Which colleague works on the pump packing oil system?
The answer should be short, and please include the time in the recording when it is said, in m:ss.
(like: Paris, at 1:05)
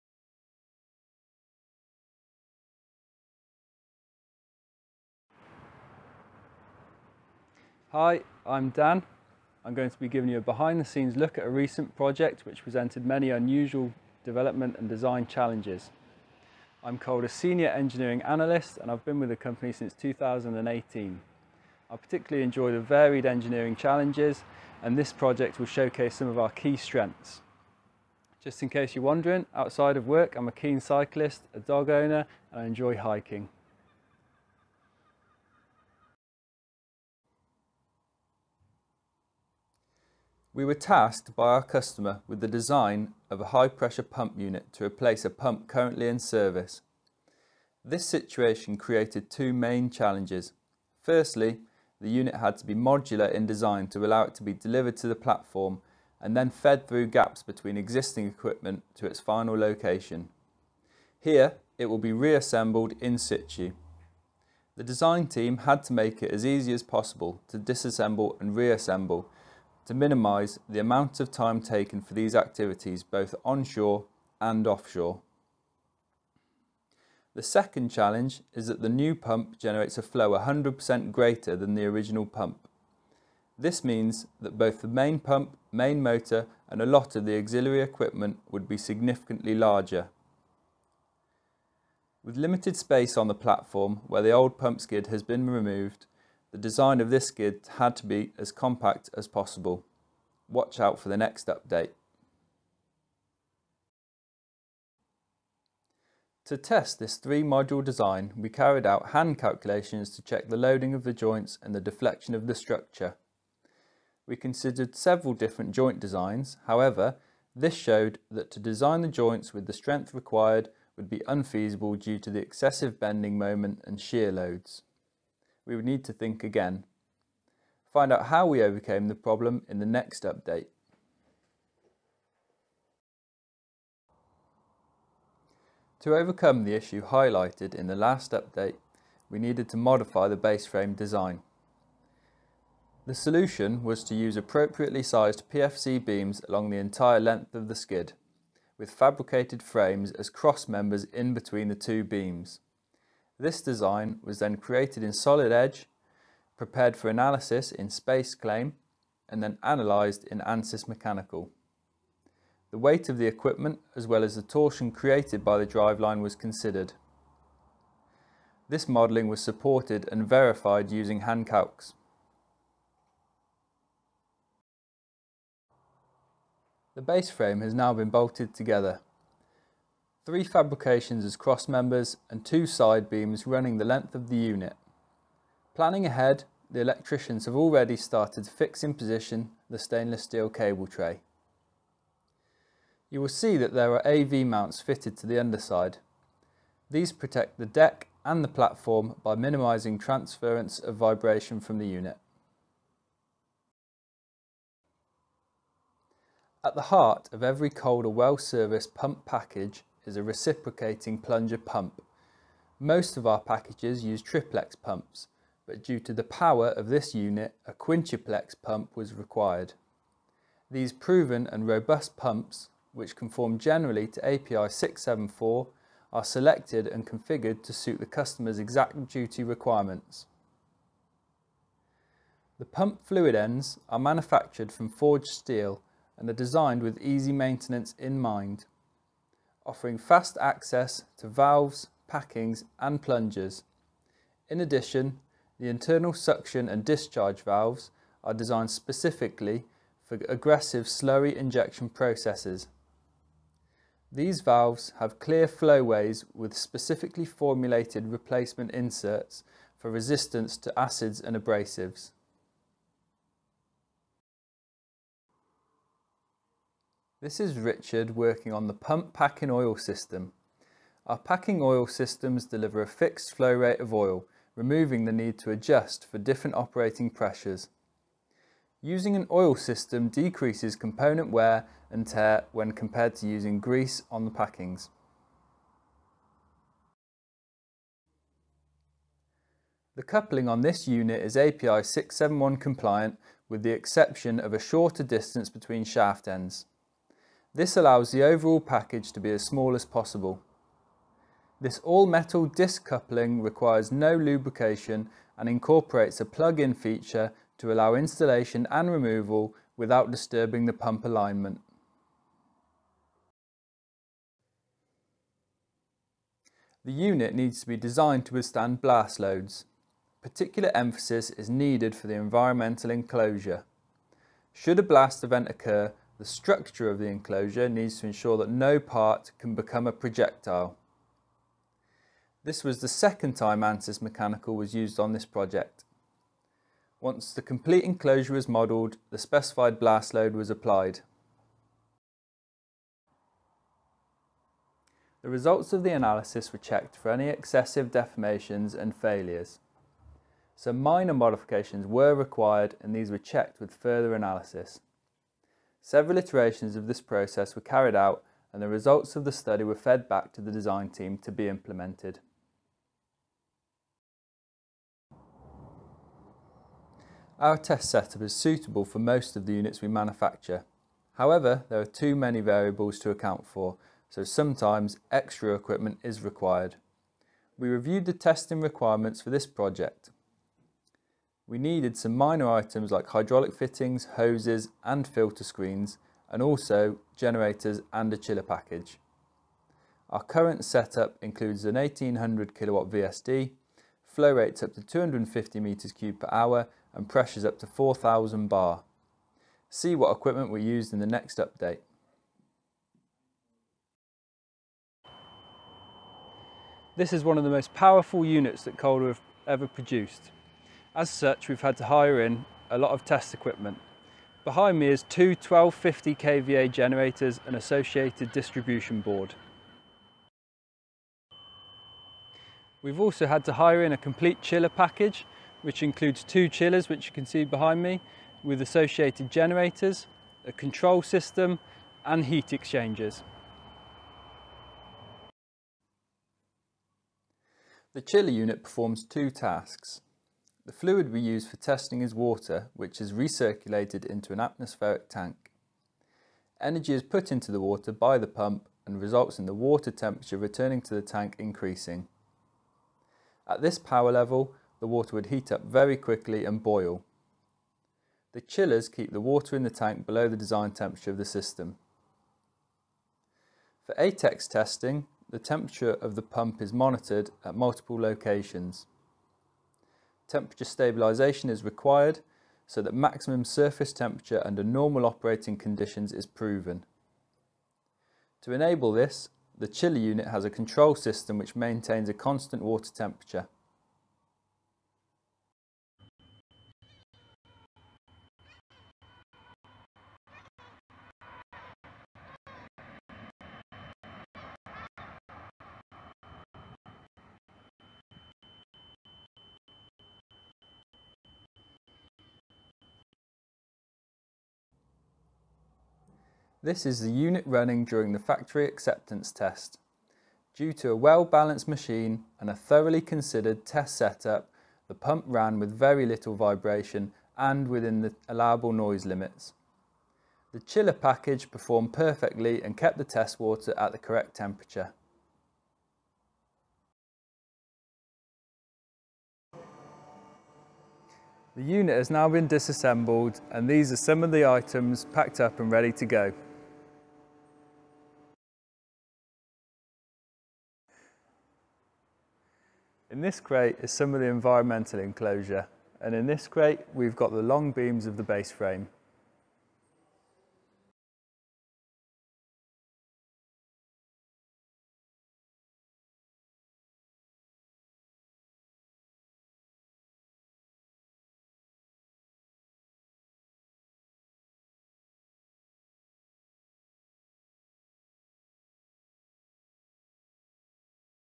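Richard, at 4:27.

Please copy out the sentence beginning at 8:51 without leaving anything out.
The unit has now been disassembled and these are some of the items packed up and ready to go.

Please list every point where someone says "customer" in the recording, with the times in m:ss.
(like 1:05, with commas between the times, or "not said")
0:41, 3:48.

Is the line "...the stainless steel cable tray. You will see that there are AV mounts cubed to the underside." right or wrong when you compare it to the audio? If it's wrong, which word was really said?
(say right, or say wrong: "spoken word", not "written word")
wrong: "fitted", not "cubed".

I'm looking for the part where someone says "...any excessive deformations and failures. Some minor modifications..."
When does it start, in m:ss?
5:47.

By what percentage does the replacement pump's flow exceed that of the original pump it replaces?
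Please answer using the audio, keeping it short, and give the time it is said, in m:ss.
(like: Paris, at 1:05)
100%, at 1:20.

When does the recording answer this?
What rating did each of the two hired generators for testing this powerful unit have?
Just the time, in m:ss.
6:55.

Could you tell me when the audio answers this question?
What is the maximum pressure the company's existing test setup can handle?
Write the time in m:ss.
6:37.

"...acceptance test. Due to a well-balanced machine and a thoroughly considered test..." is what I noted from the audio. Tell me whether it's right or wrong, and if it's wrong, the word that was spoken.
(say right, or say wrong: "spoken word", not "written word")
right.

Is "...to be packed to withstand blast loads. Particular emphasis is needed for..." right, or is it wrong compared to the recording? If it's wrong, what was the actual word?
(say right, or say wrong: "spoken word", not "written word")
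wrong: "designed", not "packed".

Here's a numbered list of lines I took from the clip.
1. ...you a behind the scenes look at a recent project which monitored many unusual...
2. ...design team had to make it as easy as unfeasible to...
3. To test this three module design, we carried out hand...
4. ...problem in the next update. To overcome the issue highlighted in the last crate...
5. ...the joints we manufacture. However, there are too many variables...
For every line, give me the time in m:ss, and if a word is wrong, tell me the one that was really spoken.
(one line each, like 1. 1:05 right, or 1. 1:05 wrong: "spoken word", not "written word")
1. 0:10 wrong: "presented", not "monitored"
2. 1:04 wrong: "possible", not "unfeasible"
3. 1:46 right
4. 2:09 wrong: "update", not "crate"
5. 6:09 wrong: "units", not "joints".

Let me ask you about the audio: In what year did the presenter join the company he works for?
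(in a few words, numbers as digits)
2018.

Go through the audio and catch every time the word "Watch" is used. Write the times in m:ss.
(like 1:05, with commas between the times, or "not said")
1:40.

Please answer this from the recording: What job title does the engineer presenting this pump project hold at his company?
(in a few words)
Senior Engineering Analyst.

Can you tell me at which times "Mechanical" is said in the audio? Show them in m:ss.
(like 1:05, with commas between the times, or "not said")
2:40, 5:34.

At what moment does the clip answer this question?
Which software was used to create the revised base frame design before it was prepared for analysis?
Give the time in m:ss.
2:35.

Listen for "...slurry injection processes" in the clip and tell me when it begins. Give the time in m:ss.
4:10.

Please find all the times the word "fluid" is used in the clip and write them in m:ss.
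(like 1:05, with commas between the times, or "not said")
3:53, 7:20.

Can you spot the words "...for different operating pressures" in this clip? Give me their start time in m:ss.
4:36.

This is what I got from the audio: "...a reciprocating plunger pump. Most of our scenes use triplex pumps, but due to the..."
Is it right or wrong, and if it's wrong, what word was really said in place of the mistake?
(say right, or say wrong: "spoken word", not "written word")
wrong: "packages", not "scenes".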